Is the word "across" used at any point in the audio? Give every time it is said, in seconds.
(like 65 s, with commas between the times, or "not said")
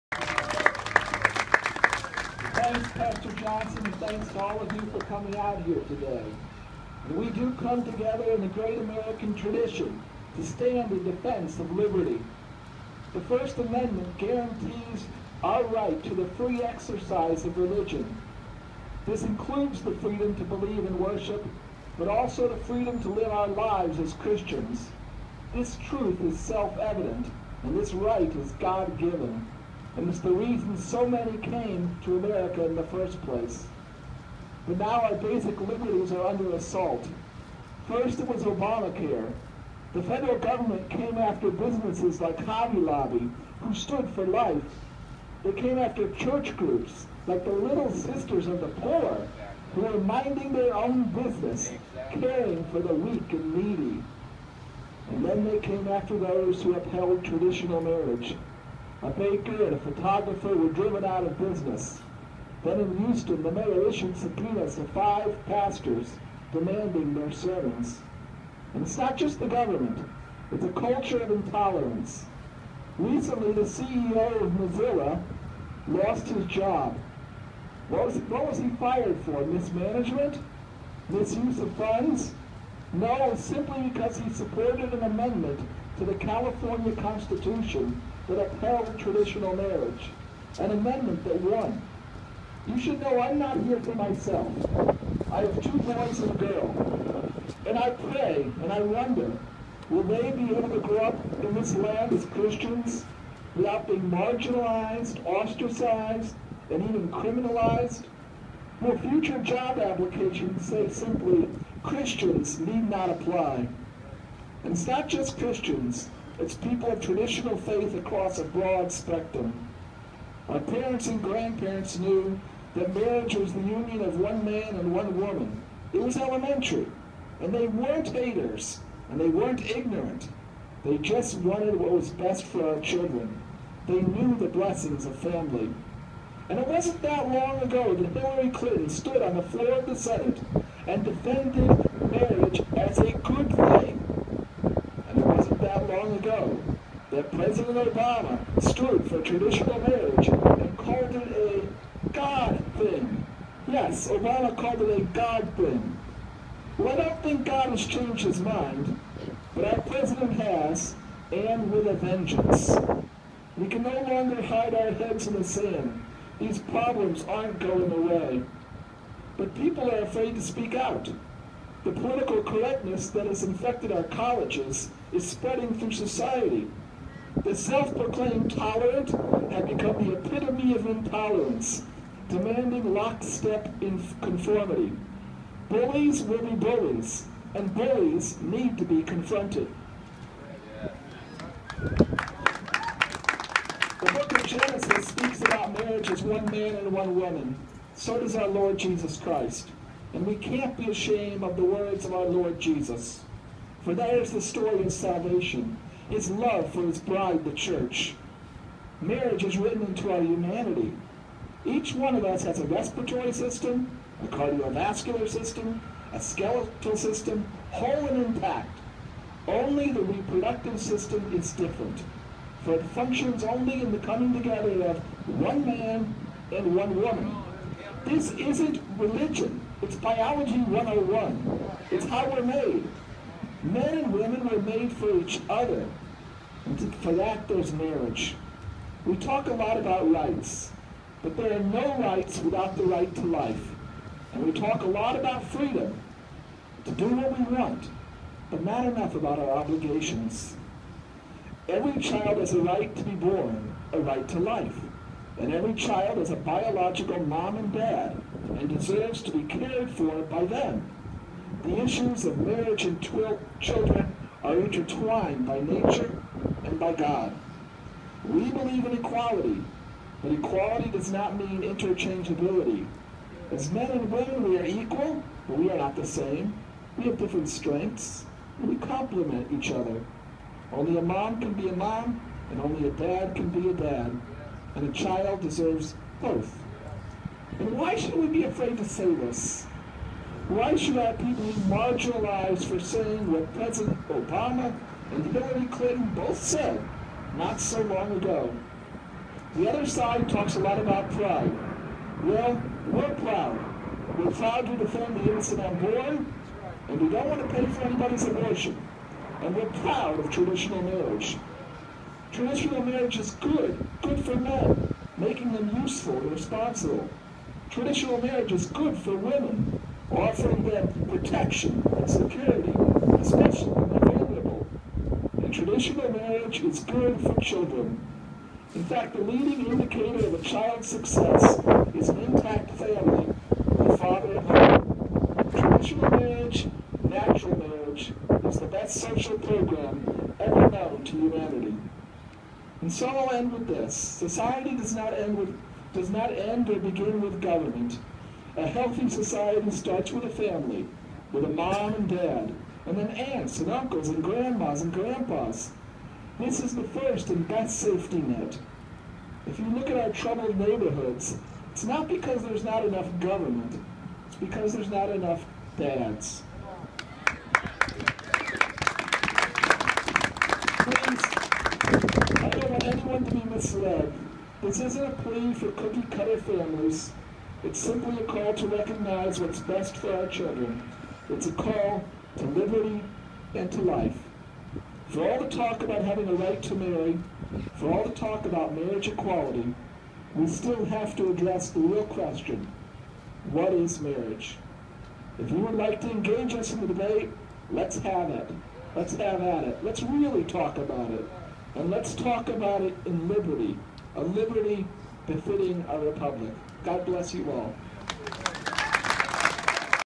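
117 s.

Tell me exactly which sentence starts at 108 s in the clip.
Will future job applications say simply, Christians need not apply?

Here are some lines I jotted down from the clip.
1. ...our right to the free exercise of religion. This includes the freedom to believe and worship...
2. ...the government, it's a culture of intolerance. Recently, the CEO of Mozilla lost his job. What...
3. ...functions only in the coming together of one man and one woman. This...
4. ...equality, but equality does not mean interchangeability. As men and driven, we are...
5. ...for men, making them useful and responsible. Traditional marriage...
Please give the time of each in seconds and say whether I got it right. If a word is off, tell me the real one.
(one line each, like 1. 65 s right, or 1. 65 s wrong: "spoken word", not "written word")
1. 15 s right
2. 69 s right
3. 222 s right
4. 268 s wrong: "women", not "driven"
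5. 314 s right.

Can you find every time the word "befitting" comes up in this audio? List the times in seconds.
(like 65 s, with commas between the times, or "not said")
405 s.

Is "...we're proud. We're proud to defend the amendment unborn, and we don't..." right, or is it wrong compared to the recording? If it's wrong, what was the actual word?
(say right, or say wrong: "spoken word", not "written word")
wrong: "innocent", not "amendment".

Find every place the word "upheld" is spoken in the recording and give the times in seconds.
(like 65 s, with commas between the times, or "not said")
56 s, 88 s.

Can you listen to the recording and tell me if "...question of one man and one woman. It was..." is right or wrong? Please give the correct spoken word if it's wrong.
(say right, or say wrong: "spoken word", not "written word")
wrong: "union", not "question".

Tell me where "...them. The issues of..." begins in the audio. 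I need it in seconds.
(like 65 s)
260 s.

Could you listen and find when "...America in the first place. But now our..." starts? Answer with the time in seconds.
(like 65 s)
32 s.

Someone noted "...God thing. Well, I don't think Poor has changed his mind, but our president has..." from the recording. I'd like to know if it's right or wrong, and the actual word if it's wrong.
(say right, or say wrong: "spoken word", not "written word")
wrong: "God", not "Poor".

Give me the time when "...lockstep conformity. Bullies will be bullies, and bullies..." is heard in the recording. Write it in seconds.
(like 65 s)
182 s.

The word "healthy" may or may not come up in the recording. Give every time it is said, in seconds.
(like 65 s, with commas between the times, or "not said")
348 s.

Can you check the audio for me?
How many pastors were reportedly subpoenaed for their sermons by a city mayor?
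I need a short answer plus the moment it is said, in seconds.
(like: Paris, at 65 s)
5, at 64 s.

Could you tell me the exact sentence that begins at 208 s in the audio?
Marriage is written into our humanity.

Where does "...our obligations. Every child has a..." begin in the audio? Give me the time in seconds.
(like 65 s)
249 s.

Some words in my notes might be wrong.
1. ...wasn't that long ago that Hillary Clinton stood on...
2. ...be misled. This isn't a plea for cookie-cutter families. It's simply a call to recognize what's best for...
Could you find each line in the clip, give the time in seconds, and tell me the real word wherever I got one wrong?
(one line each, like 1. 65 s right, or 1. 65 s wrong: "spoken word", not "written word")
1. 136 s right
2. 373 s right.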